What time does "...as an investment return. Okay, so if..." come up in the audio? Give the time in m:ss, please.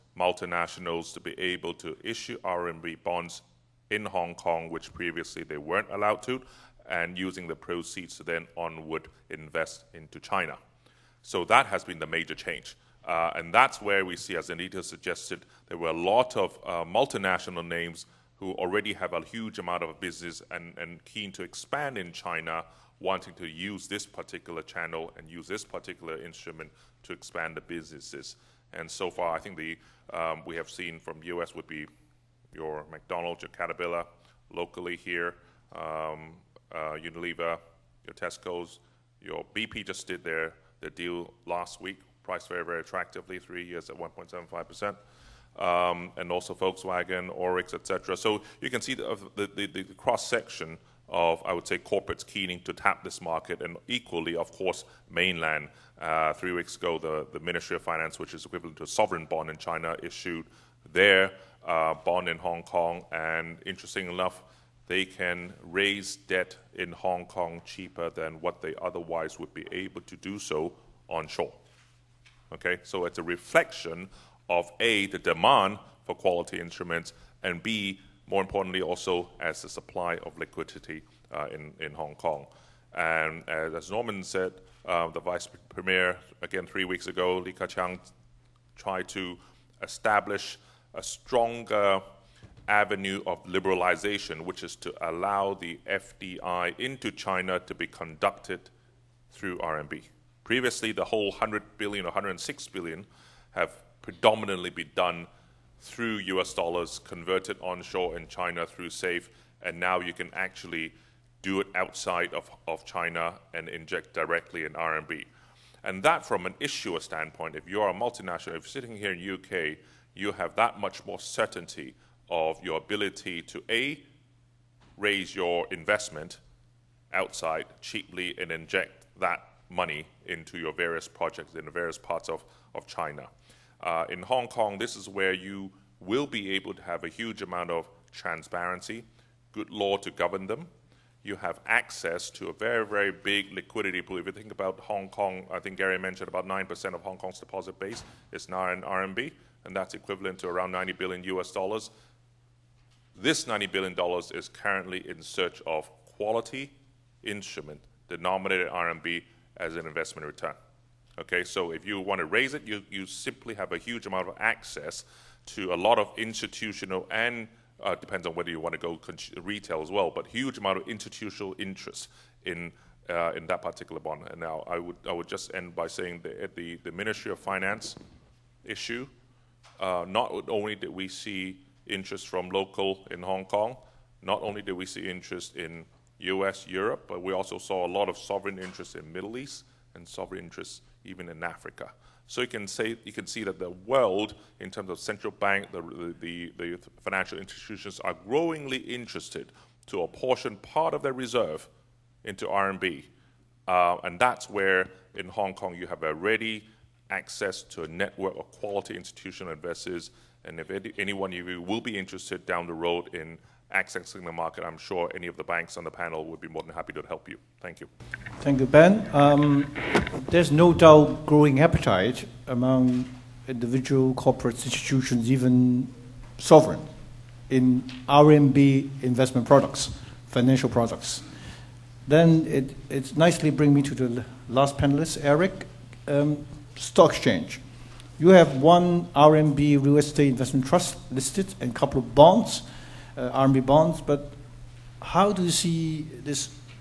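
2:39.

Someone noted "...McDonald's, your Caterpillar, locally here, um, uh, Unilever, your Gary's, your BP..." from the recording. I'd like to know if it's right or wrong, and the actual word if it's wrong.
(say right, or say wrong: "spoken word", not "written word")
wrong: "Tesco", not "Gary".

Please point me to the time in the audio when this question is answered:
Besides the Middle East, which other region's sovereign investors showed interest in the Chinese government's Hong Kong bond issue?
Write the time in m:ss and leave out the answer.
3:11.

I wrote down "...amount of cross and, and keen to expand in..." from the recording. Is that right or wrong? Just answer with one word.
wrong.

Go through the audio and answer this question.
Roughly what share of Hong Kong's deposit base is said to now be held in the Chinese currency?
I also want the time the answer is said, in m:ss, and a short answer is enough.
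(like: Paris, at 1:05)
9%, at 2:26.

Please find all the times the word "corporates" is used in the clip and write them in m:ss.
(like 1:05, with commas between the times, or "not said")
0:51, 3:44.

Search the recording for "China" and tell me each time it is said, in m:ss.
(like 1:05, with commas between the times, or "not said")
0:10, 0:22, 0:59, 1:37, 1:48, 1:52, 2:12.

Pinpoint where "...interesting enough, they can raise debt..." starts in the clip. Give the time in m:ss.
1:03.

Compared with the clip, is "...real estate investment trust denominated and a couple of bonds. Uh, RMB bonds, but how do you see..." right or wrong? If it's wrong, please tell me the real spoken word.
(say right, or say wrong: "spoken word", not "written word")
wrong: "listed", not "denominated".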